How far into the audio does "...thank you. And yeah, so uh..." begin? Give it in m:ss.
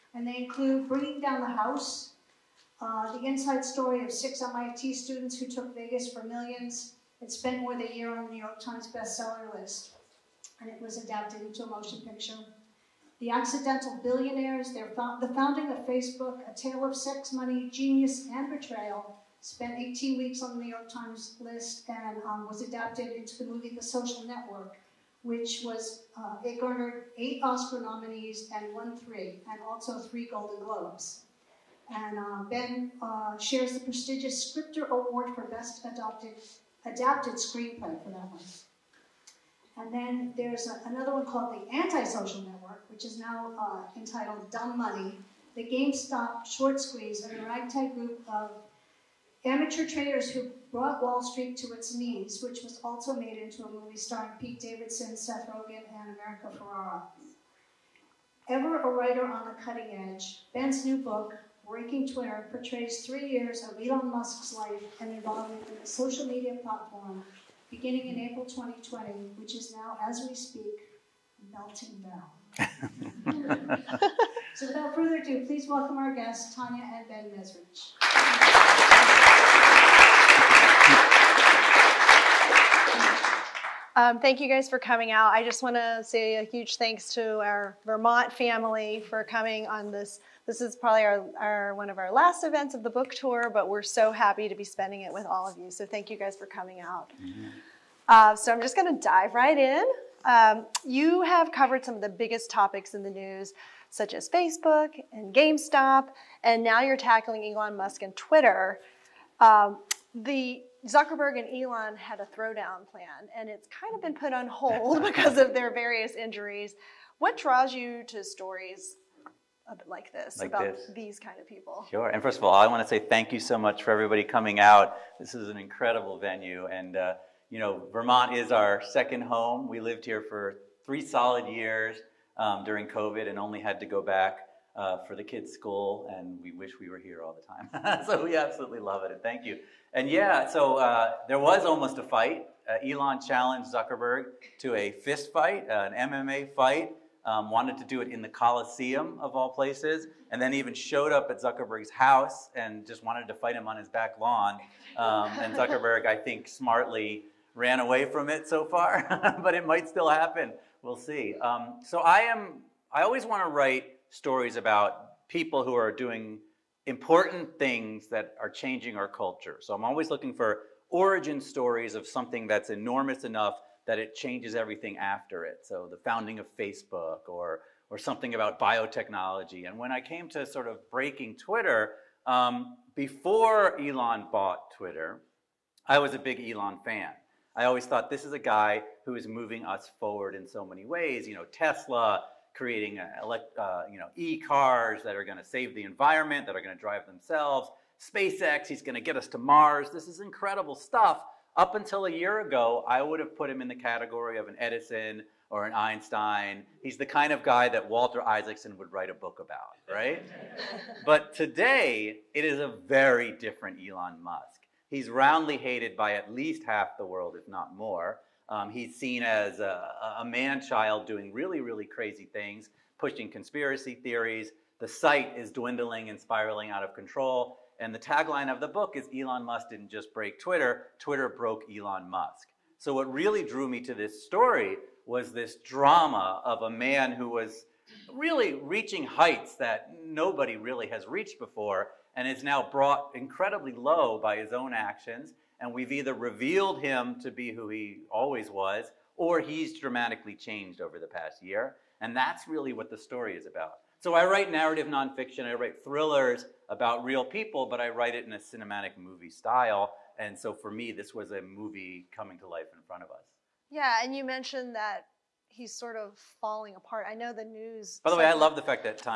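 2:19.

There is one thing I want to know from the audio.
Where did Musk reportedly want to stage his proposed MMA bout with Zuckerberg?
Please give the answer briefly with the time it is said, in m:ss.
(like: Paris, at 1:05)
The Coliseum, at 2:28.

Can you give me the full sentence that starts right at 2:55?
So the founding of Facebook or, or something about biotechnology.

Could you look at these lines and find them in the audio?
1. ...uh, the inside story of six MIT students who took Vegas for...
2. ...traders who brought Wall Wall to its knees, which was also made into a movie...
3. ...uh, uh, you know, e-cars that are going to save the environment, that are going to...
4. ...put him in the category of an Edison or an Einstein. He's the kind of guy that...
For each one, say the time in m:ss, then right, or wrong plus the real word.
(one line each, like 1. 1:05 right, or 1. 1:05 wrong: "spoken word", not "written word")
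1. 0:02 right
2. 0:49 wrong: "Street", not "Wall"
3. 3:12 right
4. 3:23 right.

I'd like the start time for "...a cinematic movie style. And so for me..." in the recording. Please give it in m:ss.
4:18.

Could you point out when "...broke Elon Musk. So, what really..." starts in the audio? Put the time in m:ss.
3:51.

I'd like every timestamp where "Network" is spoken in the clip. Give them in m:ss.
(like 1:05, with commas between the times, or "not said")
0:24, 0:42.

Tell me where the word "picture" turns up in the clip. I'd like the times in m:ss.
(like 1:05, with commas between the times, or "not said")
0:12.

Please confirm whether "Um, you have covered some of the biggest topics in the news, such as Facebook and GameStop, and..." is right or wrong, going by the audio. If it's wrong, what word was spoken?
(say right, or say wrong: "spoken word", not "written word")
right.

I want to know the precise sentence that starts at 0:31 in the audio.
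And uh, Ben uh, shares the prestigious Scripter Award for Best Adopted adapted screenplay for that one.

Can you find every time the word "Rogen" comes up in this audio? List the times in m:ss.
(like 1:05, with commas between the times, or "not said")
0:55.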